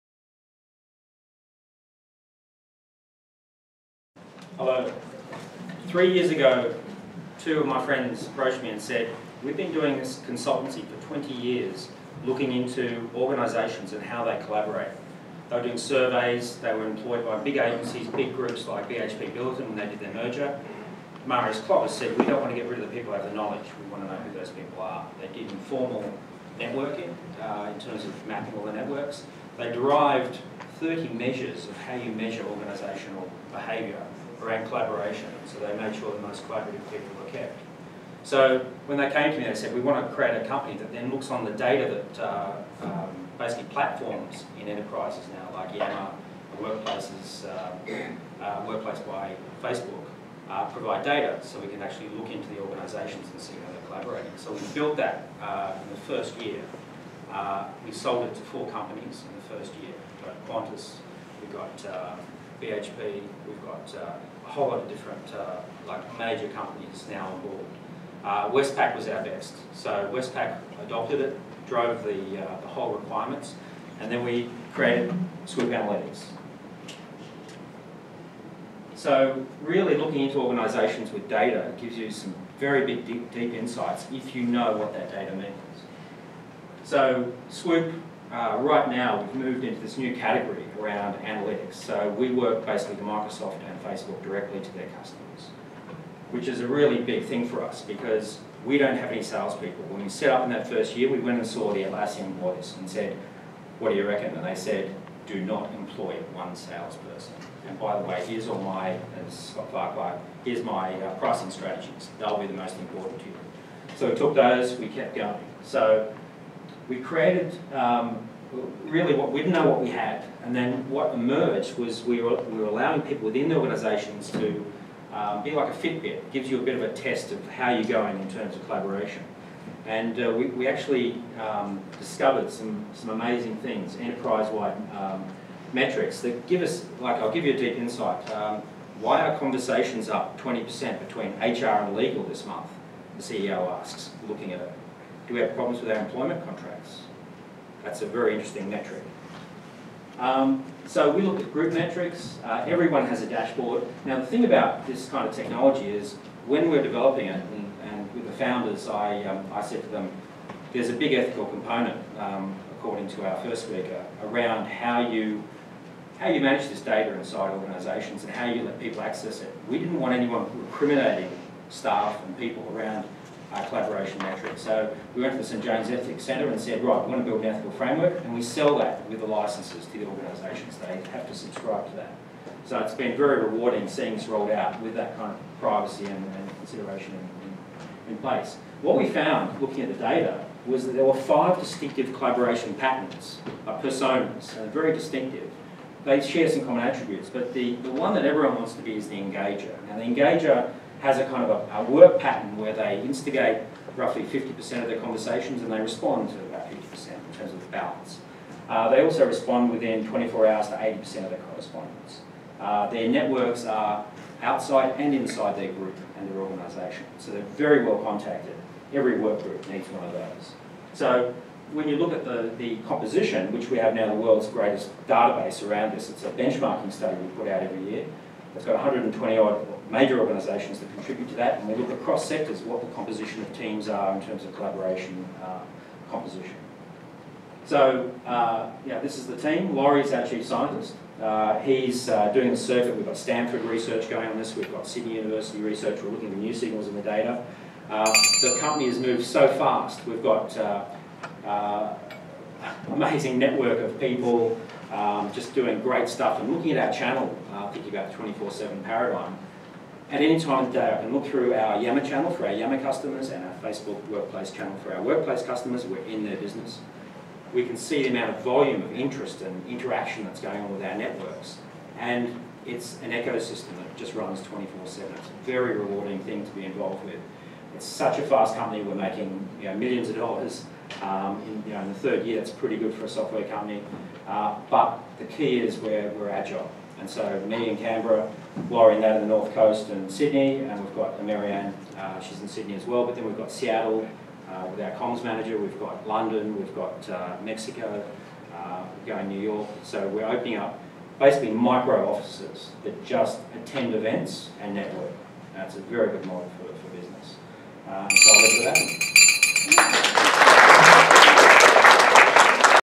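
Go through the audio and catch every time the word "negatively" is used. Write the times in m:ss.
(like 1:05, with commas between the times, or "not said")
not said.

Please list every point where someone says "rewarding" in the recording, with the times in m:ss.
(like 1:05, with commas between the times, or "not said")
3:03, 4:35.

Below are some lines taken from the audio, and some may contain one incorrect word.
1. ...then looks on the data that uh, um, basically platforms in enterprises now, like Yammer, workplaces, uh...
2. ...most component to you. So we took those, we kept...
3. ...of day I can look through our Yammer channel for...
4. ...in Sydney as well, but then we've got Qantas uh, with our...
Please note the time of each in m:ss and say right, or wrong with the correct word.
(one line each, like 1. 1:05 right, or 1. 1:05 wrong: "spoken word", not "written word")
1. 0:40 right
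2. 1:52 wrong: "important", not "component"
3. 4:20 right
4. 4:52 wrong: "Seattle", not "Qantas".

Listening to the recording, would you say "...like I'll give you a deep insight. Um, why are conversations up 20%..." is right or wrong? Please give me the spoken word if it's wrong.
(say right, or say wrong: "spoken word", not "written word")
right.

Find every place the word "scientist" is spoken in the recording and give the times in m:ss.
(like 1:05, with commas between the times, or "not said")
4:00.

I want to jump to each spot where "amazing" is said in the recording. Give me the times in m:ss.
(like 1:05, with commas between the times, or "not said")
2:13, 4:12.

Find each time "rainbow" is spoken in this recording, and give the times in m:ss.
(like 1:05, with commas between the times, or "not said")
not said.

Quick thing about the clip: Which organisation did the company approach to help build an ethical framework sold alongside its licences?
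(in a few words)
St James Ethics Centre.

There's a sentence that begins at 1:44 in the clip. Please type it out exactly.
And they said, do not employ one salesperson.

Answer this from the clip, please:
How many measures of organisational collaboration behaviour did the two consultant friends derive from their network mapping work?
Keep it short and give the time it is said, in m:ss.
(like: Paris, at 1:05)
30, at 0:30.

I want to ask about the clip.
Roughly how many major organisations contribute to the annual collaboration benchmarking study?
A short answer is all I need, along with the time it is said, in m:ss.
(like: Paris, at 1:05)
120, at 3:48.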